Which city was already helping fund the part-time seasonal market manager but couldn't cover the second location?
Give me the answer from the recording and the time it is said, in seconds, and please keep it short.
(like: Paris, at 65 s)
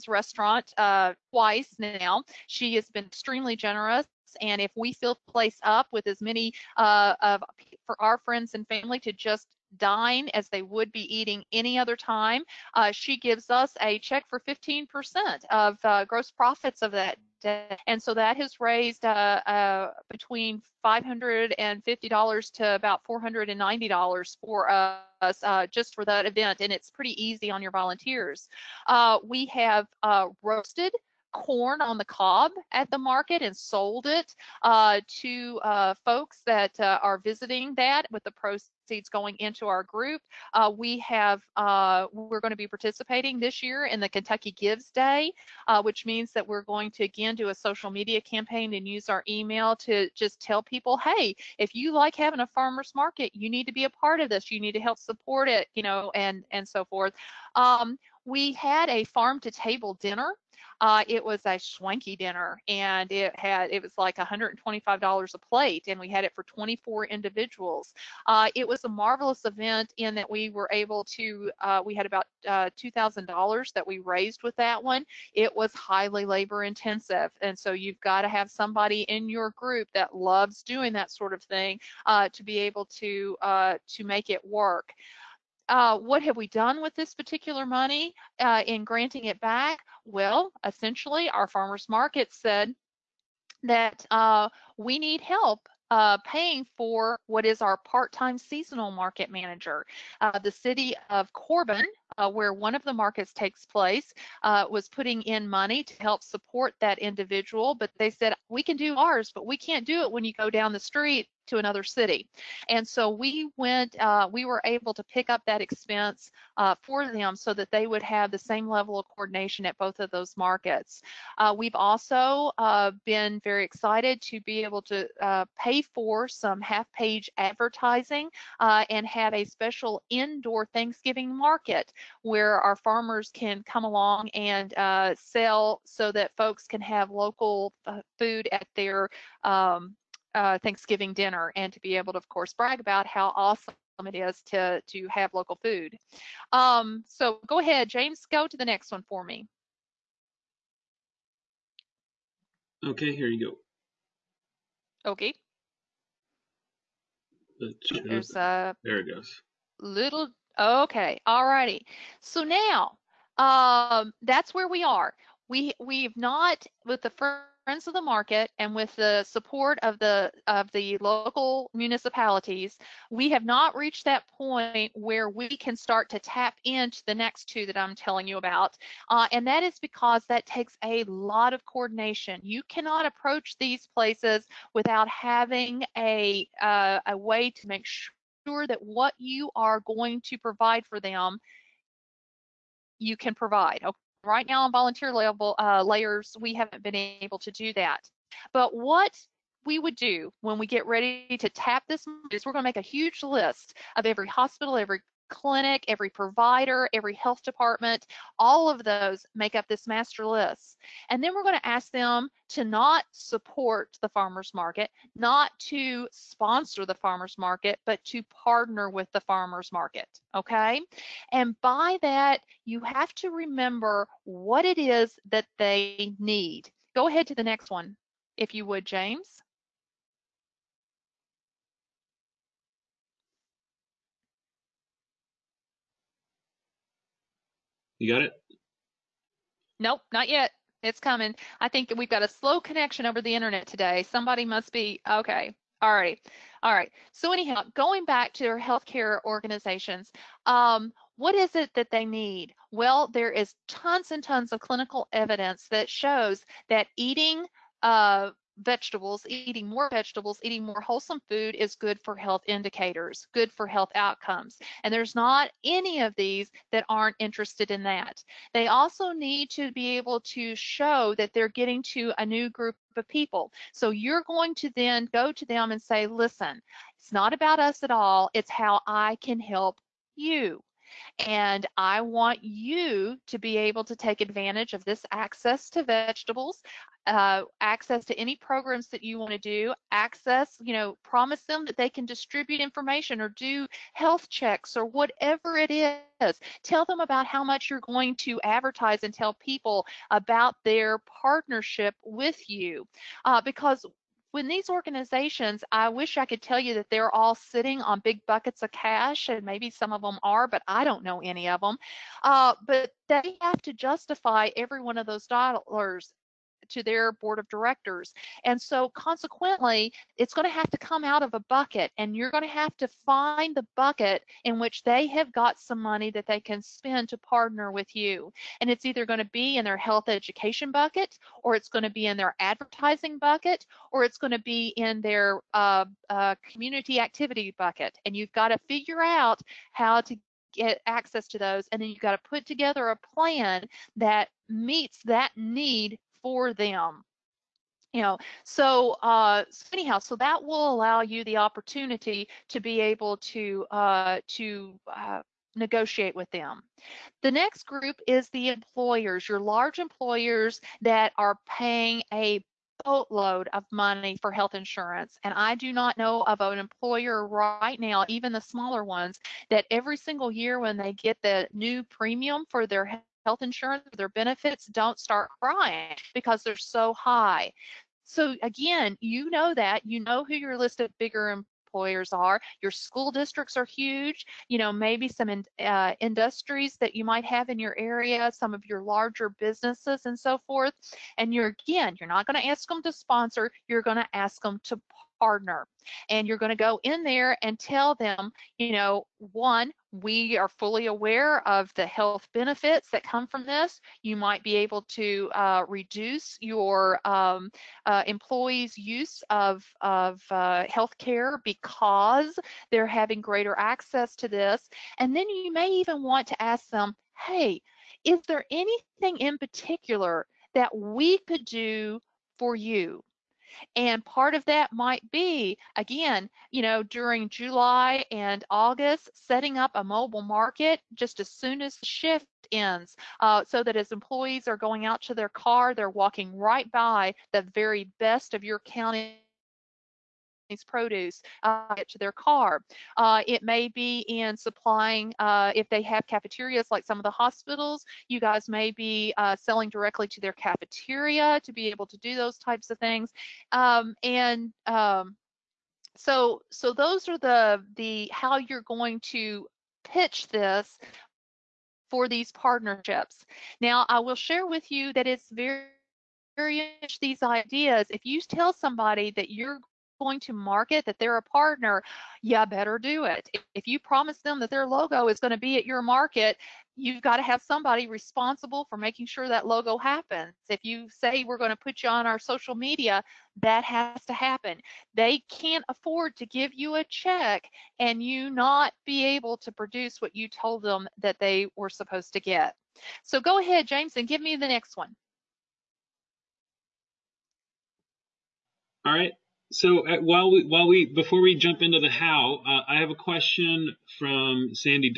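Corbin, at 101 s.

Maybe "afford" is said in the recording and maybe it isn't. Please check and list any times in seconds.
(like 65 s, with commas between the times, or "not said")
485 s.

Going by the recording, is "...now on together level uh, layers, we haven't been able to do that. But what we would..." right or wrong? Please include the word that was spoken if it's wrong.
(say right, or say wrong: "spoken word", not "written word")
wrong: "volunteer", not "together".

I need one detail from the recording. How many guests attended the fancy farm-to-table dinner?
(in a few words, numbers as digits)
24.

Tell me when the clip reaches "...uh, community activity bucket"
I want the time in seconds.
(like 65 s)
336 s.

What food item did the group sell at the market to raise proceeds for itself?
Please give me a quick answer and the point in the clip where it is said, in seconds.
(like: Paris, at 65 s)
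roasted corn on the cob, at 30 s.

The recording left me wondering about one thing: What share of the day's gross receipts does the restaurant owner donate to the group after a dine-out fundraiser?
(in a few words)
15%.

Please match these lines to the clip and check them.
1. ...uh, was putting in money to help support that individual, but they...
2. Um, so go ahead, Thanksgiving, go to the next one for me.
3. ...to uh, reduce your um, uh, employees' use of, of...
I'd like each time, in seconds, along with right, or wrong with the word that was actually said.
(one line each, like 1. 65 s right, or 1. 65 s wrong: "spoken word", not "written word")
1. 104 s right
2. 146 s wrong: "James", not "Thanksgiving"
3. 404 s right.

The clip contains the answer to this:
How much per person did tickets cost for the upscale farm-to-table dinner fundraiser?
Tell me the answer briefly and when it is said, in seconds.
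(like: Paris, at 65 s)
$125, at 64 s.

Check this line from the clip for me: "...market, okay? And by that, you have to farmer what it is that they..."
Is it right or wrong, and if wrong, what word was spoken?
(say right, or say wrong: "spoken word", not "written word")
wrong: "remember", not "farmer".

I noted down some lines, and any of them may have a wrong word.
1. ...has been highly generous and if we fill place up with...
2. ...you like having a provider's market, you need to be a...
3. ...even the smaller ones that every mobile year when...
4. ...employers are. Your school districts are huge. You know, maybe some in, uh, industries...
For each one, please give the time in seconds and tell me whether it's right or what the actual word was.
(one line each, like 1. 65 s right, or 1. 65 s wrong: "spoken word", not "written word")
1. 2 s wrong: "extremely", not "highly"
2. 51 s wrong: "farmer", not "provider"
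3. 368 s wrong: "single", not "mobile"
4. 381 s right.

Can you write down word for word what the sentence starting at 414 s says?
And then you may even want to ask them, hey, is there anything in particular that we could do for you?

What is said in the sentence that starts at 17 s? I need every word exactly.
And so that has raised uh, uh between $550 to about $490 for us uh, just for that event.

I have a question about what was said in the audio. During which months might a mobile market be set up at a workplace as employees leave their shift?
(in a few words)
July and August.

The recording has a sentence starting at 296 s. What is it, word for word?
Tell them about how much you're going to advertise and tell people about their partnership with you.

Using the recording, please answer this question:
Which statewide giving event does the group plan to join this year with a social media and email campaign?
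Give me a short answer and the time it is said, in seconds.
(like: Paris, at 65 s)
Kentucky Gives Day, at 44 s.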